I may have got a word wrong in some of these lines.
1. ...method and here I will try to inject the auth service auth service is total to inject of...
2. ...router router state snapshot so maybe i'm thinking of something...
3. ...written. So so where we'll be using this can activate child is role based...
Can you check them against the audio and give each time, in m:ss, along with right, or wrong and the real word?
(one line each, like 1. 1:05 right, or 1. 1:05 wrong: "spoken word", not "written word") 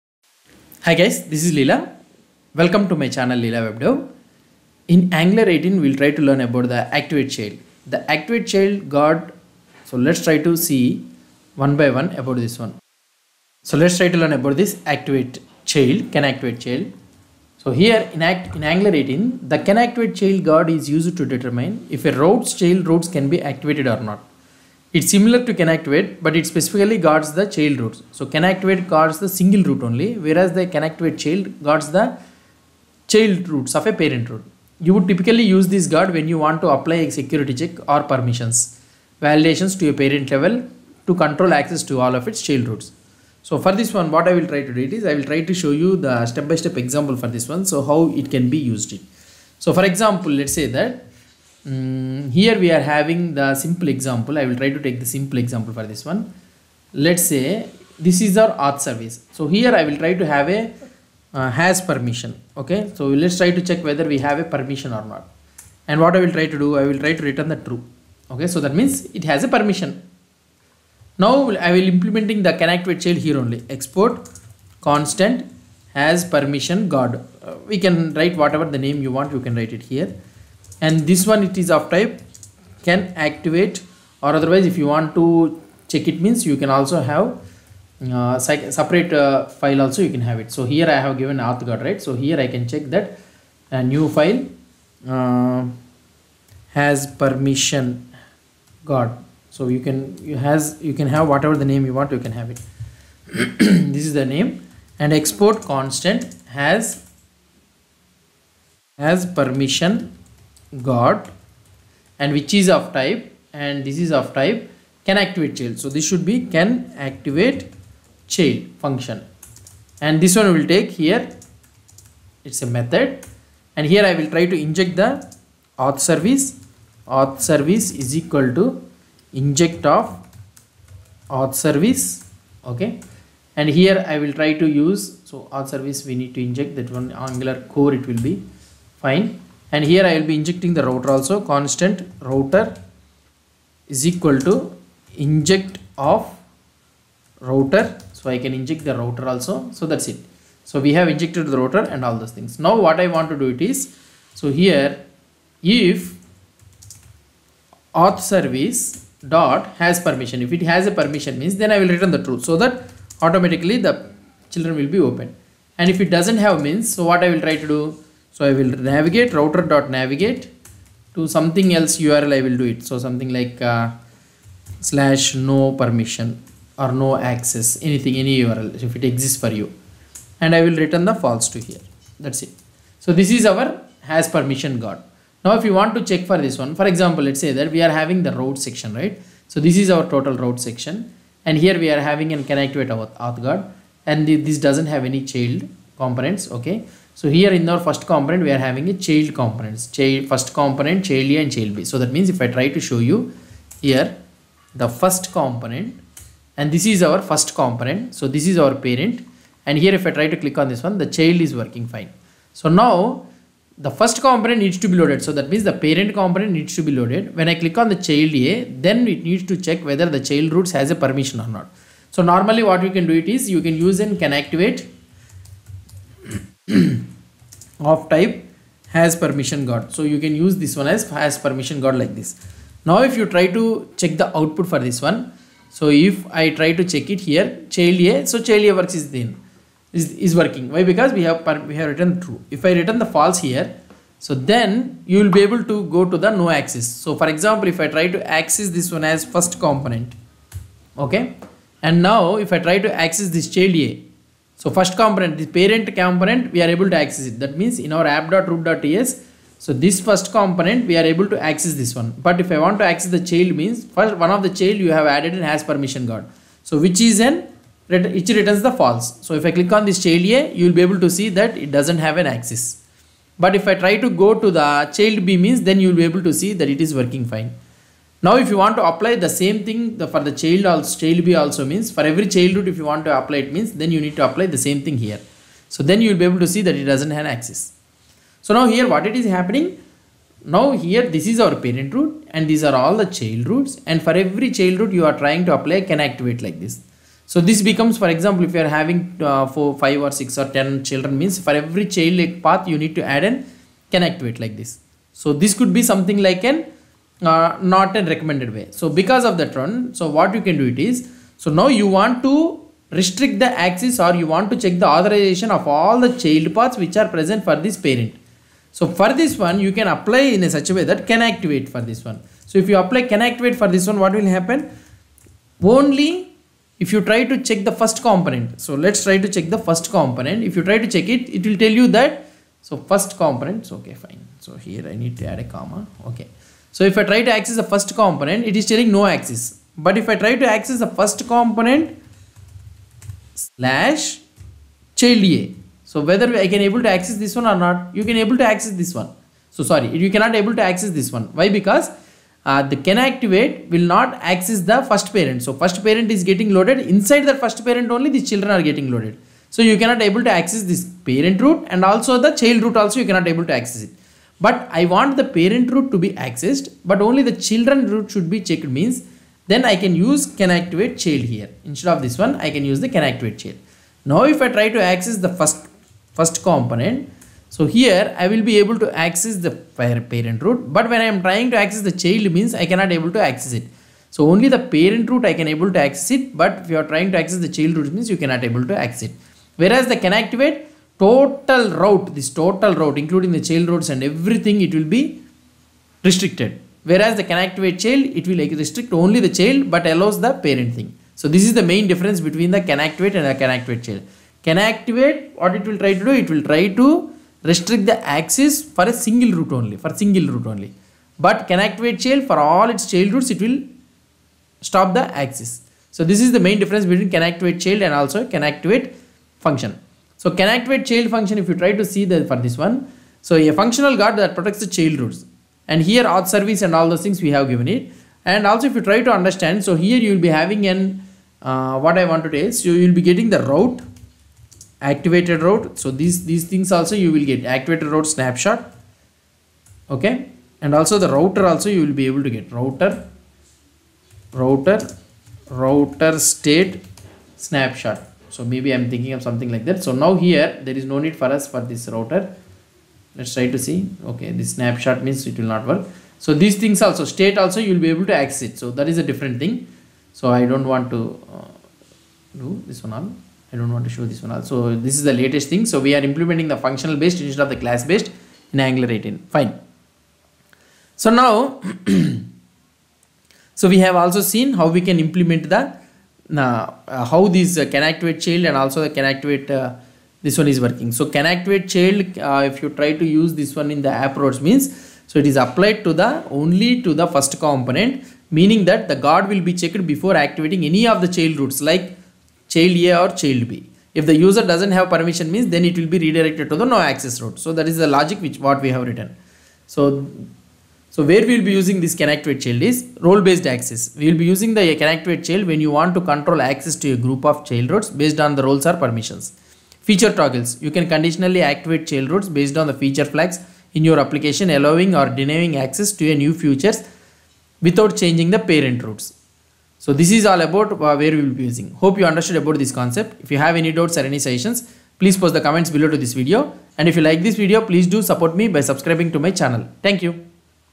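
1. 2:02 wrong: "equal", not "total"
2. 7:24 right
3. 8:18 right.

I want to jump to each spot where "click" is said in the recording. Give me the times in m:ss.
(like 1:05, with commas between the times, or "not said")
3:30, 3:37, 4:29.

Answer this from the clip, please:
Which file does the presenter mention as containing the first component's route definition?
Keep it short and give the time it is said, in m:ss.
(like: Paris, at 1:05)
app.root.ts, at 4:18.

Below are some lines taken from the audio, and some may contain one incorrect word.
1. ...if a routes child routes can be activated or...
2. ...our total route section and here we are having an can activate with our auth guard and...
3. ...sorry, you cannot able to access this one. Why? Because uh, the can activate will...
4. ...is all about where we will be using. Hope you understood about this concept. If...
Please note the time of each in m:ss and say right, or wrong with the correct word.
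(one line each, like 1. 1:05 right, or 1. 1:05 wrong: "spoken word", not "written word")
1. 0:21 right
2. 3:09 right
3. 5:49 right
4. 8:40 right.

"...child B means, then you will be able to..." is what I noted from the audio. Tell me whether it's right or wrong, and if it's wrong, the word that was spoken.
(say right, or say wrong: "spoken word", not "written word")
right.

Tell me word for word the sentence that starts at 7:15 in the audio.
So these these things also you will get activated route snapshot.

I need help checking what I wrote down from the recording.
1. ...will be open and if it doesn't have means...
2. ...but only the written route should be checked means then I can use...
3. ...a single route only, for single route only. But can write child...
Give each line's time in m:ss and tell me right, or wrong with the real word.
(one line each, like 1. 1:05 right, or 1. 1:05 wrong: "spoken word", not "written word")
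1. 2:44 right
2. 6:06 wrong: "children", not "written"
3. 6:48 wrong: "activate", not "write".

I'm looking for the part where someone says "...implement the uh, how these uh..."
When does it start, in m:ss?
7:55.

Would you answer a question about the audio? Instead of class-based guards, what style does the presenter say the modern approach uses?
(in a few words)
functional based.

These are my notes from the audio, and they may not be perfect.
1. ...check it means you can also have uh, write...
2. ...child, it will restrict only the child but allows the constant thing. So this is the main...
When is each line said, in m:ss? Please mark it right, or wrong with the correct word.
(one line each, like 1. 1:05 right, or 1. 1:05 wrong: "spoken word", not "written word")
1. 1:25 wrong: "separate", not "write"
2. 6:37 wrong: "parent", not "constant".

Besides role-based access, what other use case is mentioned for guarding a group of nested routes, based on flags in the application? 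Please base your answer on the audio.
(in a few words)
Feature toggles.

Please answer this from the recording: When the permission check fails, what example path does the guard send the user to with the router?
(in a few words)
/no permission.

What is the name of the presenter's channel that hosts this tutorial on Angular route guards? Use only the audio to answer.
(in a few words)
Leela WebDev.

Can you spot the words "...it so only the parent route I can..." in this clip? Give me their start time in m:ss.
6:23.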